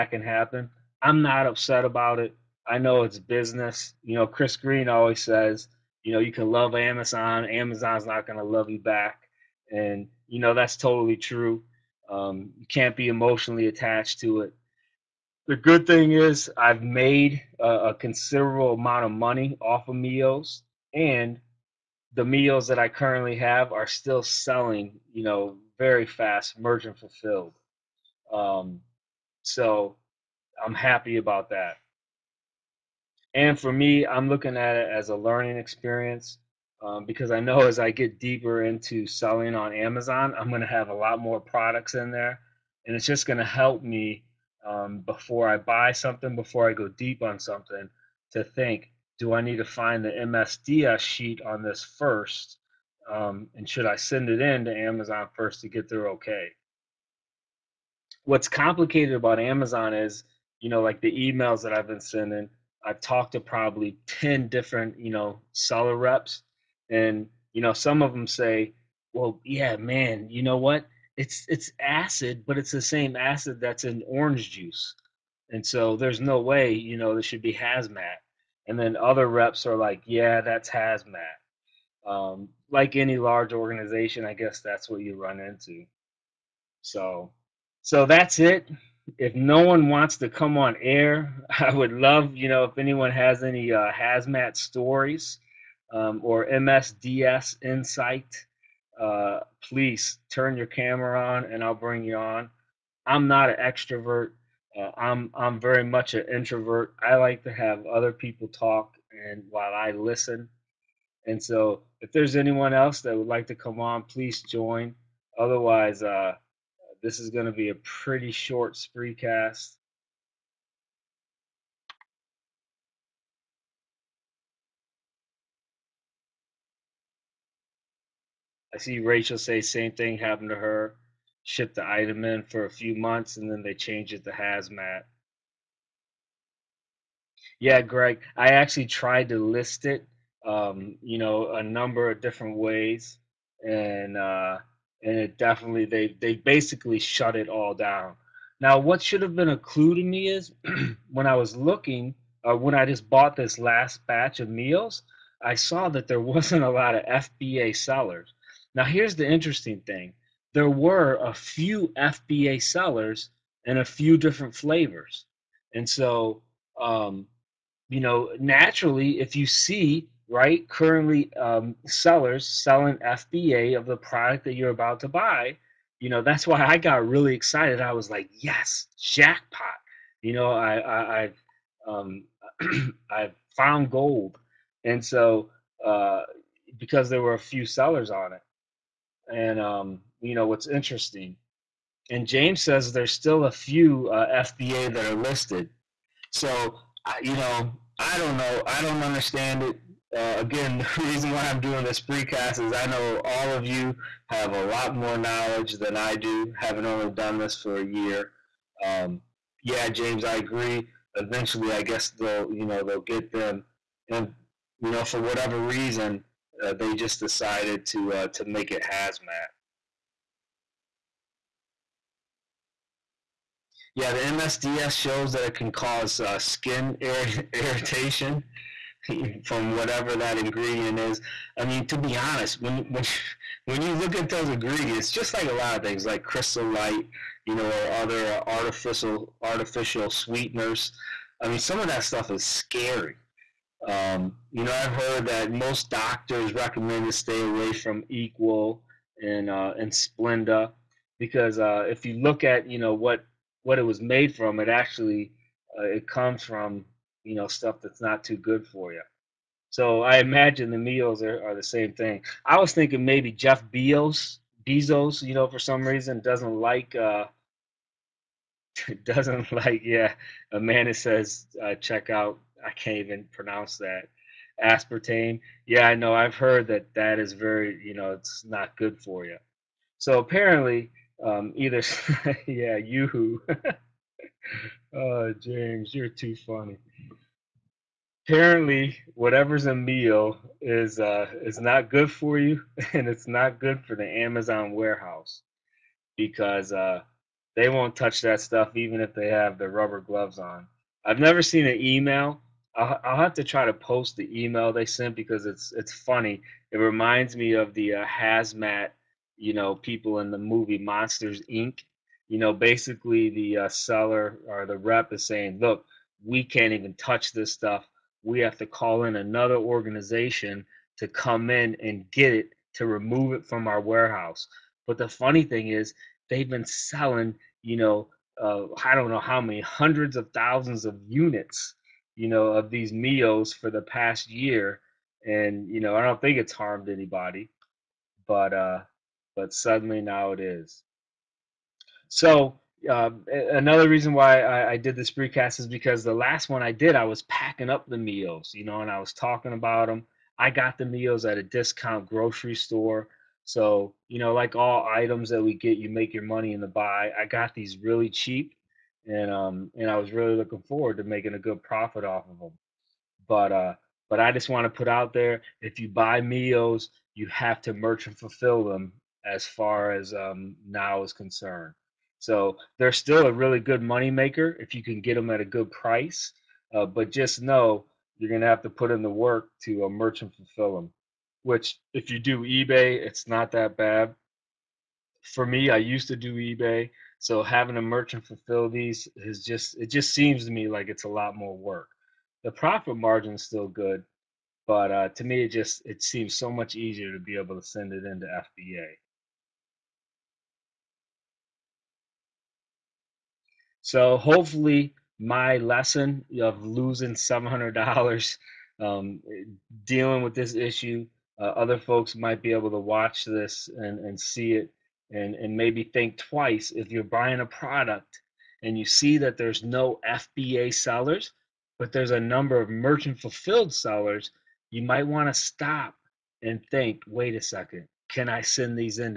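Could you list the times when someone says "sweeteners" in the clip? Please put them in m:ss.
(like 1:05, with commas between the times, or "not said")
4:00.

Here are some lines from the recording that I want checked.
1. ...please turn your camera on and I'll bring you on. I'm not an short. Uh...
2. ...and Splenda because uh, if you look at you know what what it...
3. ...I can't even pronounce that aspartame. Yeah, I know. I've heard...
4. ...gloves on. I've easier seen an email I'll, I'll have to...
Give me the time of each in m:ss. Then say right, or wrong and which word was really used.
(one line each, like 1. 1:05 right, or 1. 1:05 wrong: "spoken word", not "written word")
1. 1:39 wrong: "extrovert", not "short"
2. 4:09 right
3. 4:32 right
4. 4:59 wrong: "never", not "easier".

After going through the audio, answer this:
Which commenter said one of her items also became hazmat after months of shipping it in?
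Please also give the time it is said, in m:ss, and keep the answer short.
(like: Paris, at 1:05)
Rachel, at 2:08.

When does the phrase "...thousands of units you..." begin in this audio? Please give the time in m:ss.
5:30.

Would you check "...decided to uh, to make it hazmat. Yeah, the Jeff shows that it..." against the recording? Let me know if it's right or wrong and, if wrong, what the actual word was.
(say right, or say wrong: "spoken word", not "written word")
wrong: "MSDS", not "Jeff".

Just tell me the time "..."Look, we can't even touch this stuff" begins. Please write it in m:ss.
5:15.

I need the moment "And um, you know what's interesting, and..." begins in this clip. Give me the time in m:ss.
3:09.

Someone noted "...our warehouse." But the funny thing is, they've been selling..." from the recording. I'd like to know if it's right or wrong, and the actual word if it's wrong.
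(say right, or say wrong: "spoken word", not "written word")
right.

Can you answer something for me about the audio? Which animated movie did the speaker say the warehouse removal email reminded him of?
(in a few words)
Monsters Inc.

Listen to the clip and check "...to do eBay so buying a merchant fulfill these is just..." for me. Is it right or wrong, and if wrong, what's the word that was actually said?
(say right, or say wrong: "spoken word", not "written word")
wrong: "having", not "buying".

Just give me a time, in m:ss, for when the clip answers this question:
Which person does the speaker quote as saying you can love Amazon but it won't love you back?
0:04.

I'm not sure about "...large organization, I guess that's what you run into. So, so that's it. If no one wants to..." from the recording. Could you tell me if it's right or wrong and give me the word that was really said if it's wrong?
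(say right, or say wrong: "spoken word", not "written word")
right.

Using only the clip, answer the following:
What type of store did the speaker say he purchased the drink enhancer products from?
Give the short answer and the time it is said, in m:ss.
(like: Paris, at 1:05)
Discount grocery store, at 5:51.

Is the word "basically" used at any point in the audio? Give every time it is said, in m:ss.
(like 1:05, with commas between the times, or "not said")
2:26, 5:12.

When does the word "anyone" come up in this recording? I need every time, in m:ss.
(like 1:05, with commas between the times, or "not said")
1:32, 1:52.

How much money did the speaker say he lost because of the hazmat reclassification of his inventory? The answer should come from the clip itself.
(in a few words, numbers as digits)
$700.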